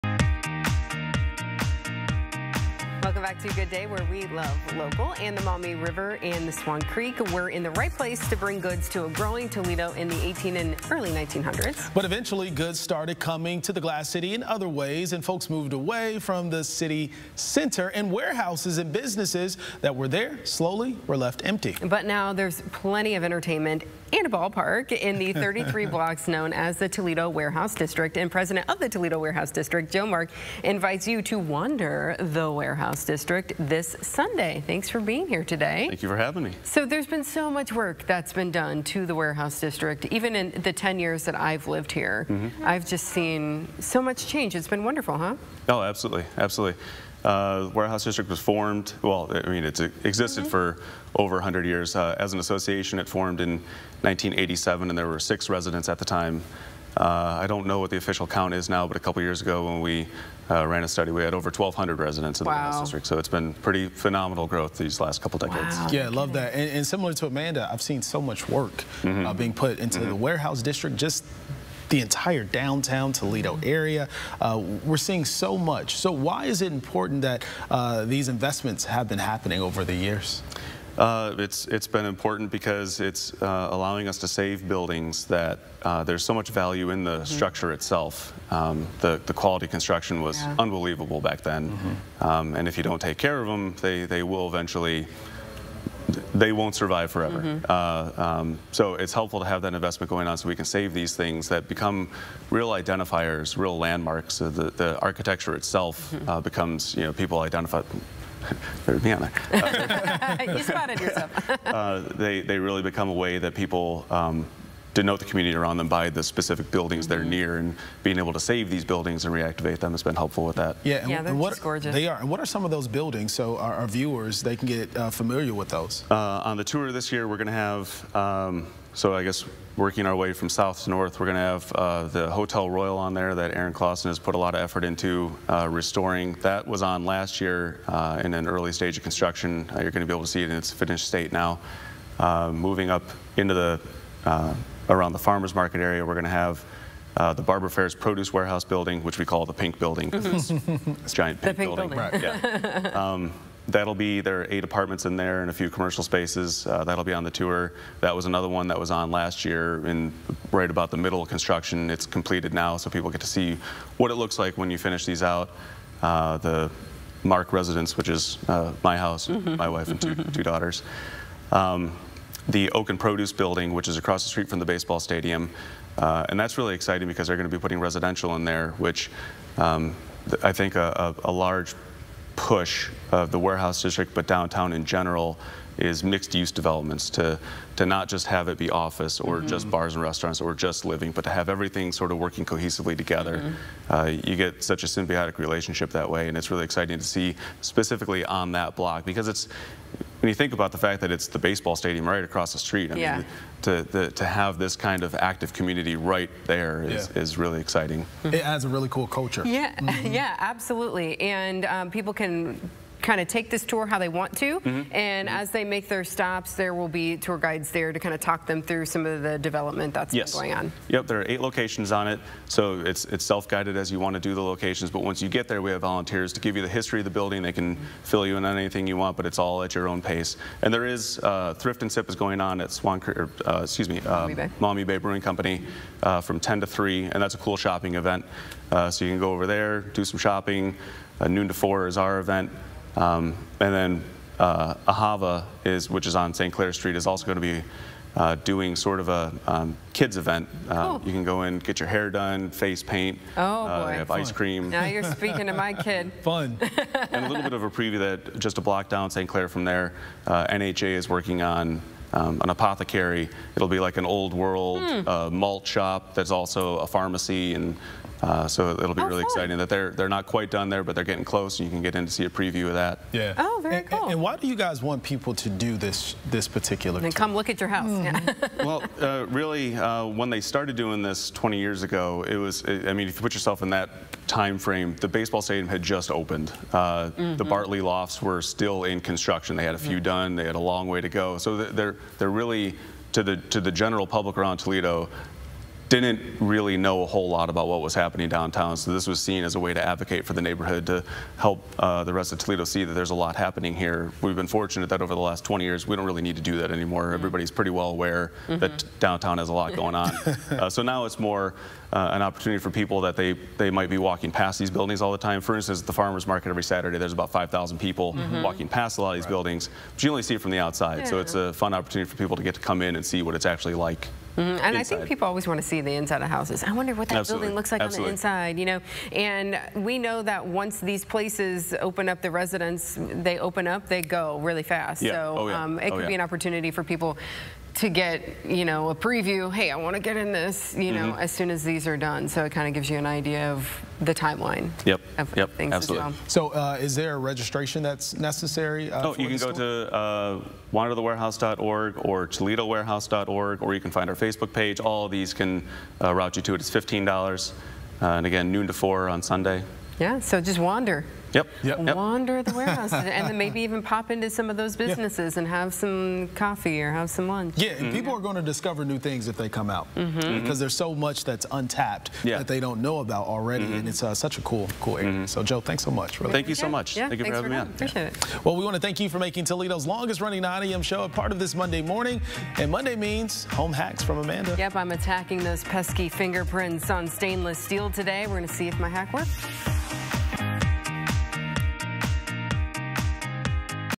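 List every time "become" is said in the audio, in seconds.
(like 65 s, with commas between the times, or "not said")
101 s, 106 s, 112 s.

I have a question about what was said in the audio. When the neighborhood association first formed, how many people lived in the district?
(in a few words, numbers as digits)
6.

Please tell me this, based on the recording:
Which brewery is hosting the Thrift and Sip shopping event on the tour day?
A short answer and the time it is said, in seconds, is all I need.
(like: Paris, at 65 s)
Maumee Bay Brewing Company, at 234 s.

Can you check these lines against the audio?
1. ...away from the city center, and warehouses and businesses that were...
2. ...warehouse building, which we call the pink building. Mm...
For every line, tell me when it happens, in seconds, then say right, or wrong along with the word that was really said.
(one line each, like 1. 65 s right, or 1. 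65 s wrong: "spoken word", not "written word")
1. 15 s right
2. 148 s right.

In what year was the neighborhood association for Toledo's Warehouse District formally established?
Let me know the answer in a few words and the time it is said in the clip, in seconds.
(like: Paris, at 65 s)
1987, at 54 s.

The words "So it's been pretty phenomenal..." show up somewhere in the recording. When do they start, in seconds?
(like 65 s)
63 s.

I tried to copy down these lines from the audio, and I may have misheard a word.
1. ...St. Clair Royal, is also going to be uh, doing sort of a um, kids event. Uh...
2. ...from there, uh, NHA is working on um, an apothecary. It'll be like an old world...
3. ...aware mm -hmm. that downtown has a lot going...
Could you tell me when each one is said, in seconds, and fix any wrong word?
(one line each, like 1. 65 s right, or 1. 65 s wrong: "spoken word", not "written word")
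1. 246 s wrong: "Street", not "Royal"
2. 259 s right
3. 307 s right.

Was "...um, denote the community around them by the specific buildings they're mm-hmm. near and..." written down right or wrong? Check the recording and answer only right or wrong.
right.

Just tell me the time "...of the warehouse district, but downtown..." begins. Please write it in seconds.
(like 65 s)
183 s.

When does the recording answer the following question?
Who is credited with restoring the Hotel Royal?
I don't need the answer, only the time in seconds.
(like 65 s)
133 s.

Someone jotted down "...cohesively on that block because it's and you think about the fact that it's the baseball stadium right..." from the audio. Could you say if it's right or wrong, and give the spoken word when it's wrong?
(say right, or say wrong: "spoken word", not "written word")
wrong: "specifically", not "cohesively".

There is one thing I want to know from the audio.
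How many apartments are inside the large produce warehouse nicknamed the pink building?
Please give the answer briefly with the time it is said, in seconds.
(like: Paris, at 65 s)
8, at 154 s.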